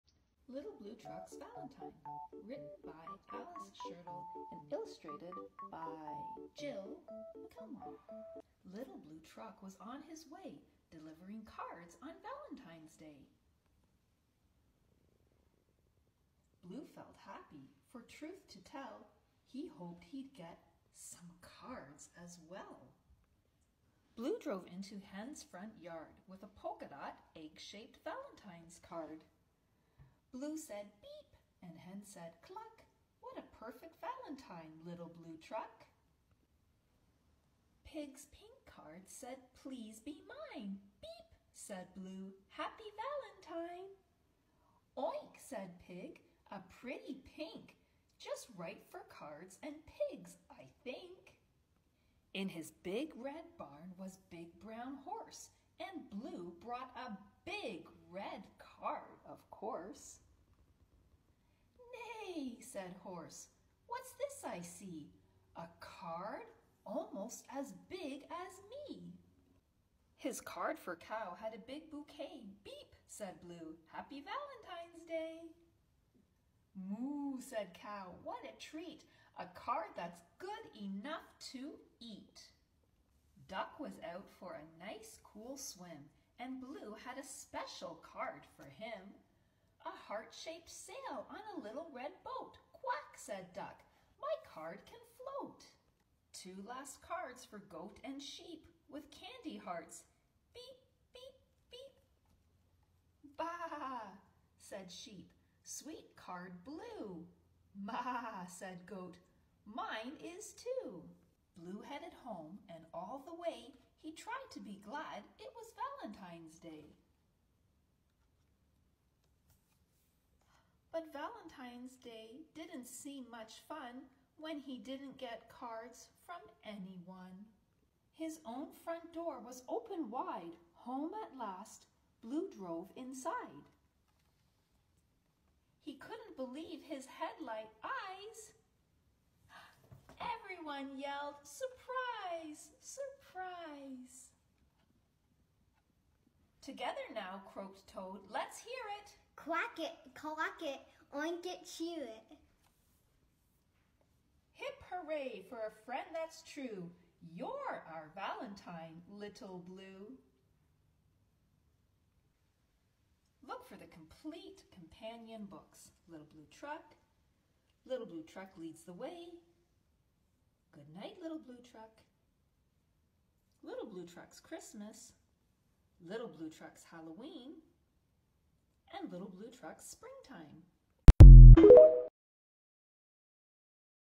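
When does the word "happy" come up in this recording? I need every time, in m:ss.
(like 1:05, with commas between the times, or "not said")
0:17, 0:42, 1:13.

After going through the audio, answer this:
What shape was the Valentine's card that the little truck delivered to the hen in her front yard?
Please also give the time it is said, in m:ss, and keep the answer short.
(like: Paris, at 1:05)
Egg-shaped, at 0:27.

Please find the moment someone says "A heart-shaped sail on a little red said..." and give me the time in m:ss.
1:29.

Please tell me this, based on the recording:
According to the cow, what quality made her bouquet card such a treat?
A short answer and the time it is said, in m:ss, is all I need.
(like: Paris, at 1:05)
Good enough to eat, at 1:20.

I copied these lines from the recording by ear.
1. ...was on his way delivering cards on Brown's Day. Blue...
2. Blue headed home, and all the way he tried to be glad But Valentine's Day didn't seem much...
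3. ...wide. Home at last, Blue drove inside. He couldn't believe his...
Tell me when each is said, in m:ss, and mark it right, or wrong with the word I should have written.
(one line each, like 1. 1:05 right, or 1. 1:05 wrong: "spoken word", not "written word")
1. 0:09 wrong: "Valentine", not "Brown"
2. 1:51 right
3. 2:10 right.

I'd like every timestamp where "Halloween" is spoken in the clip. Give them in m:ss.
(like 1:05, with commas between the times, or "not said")
2:56.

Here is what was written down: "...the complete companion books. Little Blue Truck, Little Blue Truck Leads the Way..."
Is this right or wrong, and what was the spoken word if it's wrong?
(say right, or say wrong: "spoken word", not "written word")
right.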